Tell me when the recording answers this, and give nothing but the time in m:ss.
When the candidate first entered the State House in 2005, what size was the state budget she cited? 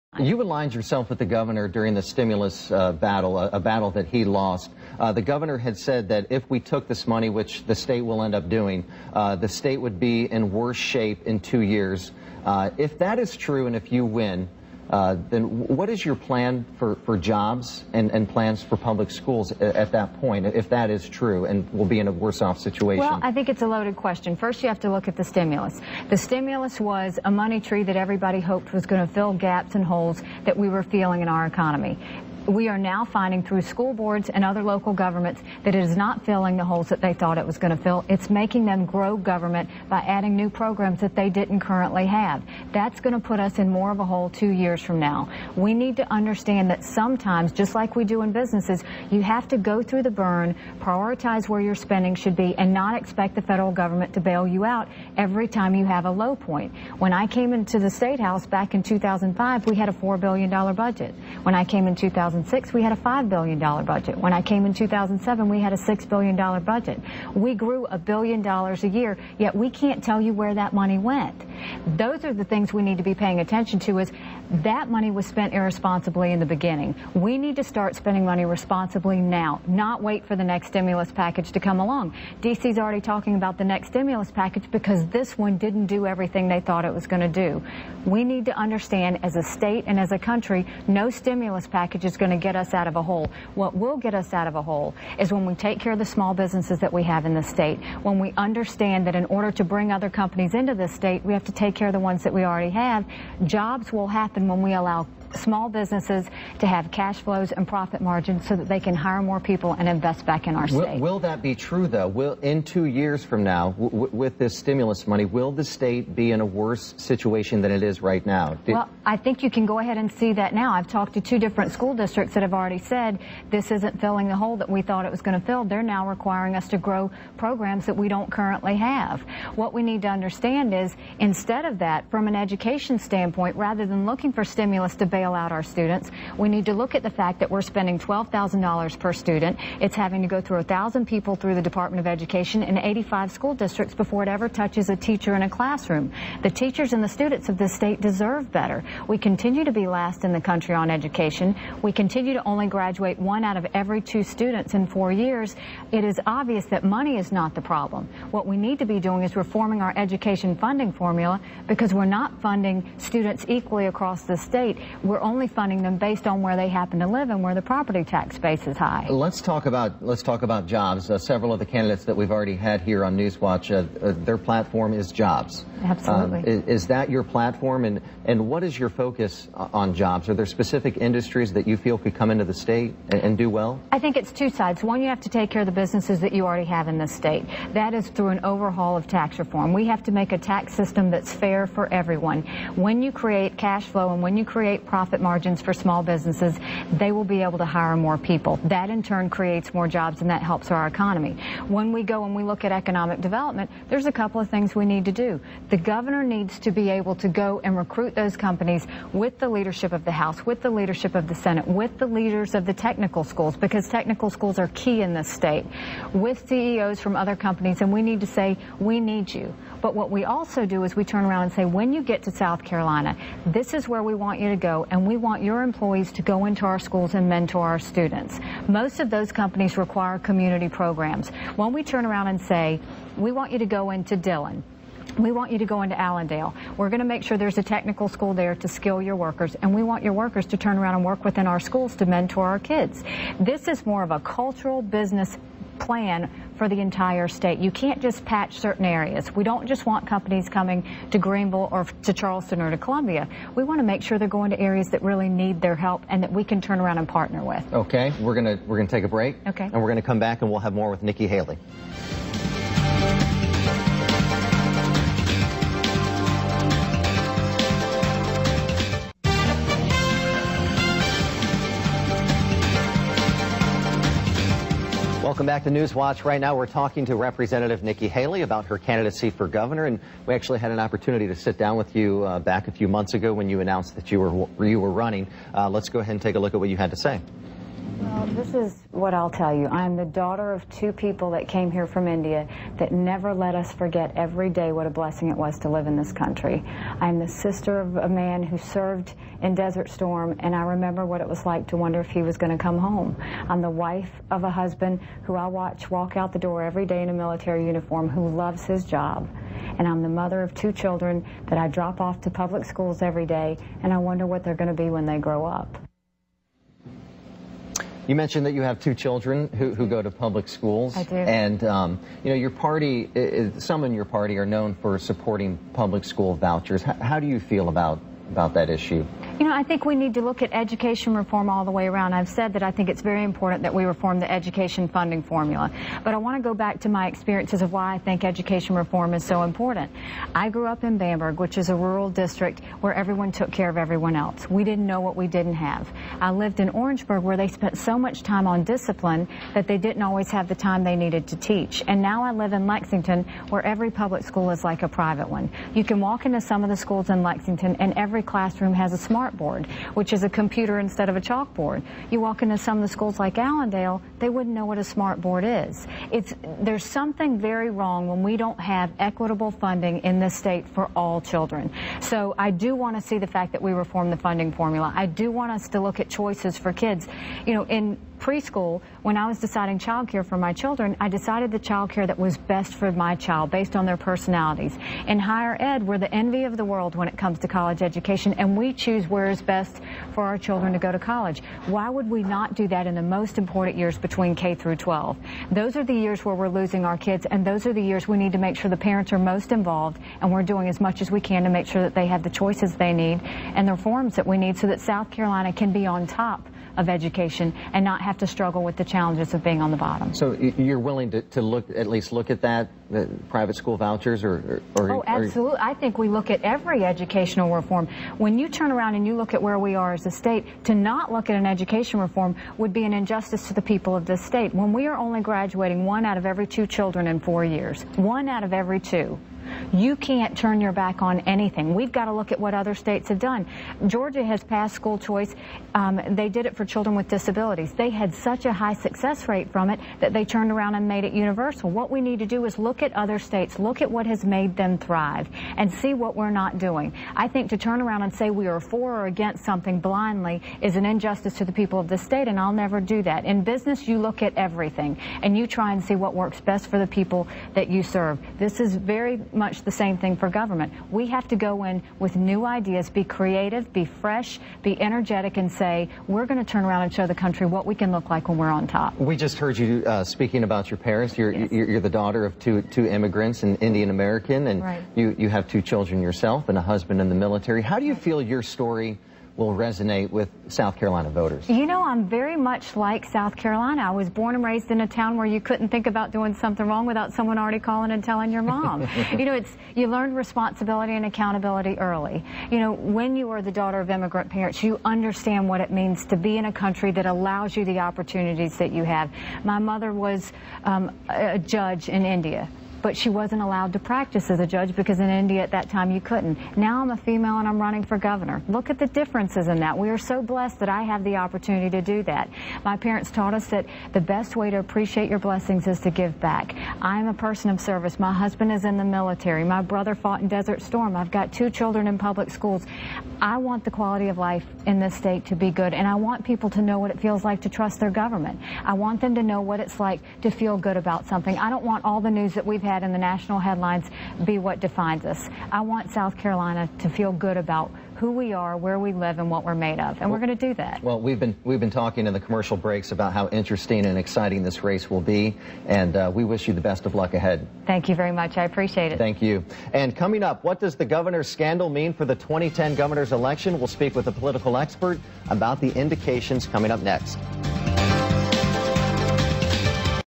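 0:59.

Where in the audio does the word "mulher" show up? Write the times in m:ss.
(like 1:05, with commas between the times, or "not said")
1:44.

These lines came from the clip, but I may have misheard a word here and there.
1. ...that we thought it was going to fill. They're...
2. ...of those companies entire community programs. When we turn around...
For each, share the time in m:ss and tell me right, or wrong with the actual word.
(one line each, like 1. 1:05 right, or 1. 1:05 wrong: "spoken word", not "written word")
1. 2:04 right
2. 3:48 wrong: "require", not "entire".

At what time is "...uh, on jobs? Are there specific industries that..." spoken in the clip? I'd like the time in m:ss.
2:59.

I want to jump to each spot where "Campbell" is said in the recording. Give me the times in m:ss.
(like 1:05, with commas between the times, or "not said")
not said.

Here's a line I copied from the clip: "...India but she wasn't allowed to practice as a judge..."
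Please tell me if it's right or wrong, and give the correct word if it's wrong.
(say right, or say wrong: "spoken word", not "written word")
right.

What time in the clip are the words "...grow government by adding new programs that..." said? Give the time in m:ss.
0:38.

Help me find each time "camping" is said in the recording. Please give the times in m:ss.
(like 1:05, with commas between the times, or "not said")
not said.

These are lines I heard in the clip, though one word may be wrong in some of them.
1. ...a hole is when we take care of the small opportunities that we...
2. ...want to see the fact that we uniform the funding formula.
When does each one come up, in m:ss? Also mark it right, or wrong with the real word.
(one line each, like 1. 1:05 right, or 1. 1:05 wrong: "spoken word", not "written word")
1. 1:34 wrong: "businesses", not "opportunities"
2. 6:12 wrong: "reform", not "uniform".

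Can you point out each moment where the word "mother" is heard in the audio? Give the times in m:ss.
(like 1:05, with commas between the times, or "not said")
5:10, 8:19.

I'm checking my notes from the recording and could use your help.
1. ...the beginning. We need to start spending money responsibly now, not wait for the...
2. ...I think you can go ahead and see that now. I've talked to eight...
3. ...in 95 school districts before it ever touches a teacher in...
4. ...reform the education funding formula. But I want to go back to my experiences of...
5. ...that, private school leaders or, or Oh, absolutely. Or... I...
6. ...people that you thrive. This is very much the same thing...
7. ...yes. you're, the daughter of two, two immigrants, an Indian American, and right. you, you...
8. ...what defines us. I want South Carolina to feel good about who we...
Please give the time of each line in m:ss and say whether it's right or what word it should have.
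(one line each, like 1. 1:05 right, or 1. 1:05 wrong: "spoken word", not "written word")
1. 1:16 right
2. 1:59 wrong: "two", not "eight"
3. 2:22 wrong: "85", not "95"
4. 5:33 right
5. 6:52 wrong: "vouchers", not "leaders"
6. 7:36 wrong: "serve", not "thrive"
7. 7:51 right
8. 8:54 right.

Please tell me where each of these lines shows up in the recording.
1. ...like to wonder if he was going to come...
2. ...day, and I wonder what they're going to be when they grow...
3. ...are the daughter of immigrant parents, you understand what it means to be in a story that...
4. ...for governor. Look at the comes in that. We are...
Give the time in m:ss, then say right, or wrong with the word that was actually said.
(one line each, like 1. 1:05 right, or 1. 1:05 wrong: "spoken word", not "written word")
1. 5:01 right
2. 5:13 right
3. 8:13 wrong: "country", not "story"
4. 8:27 wrong: "differences", not "comes".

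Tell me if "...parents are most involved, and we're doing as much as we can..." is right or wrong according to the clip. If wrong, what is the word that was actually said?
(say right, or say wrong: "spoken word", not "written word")
right.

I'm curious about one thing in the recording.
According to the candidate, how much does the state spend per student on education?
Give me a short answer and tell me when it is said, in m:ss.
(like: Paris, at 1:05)
$12,000, at 2:17.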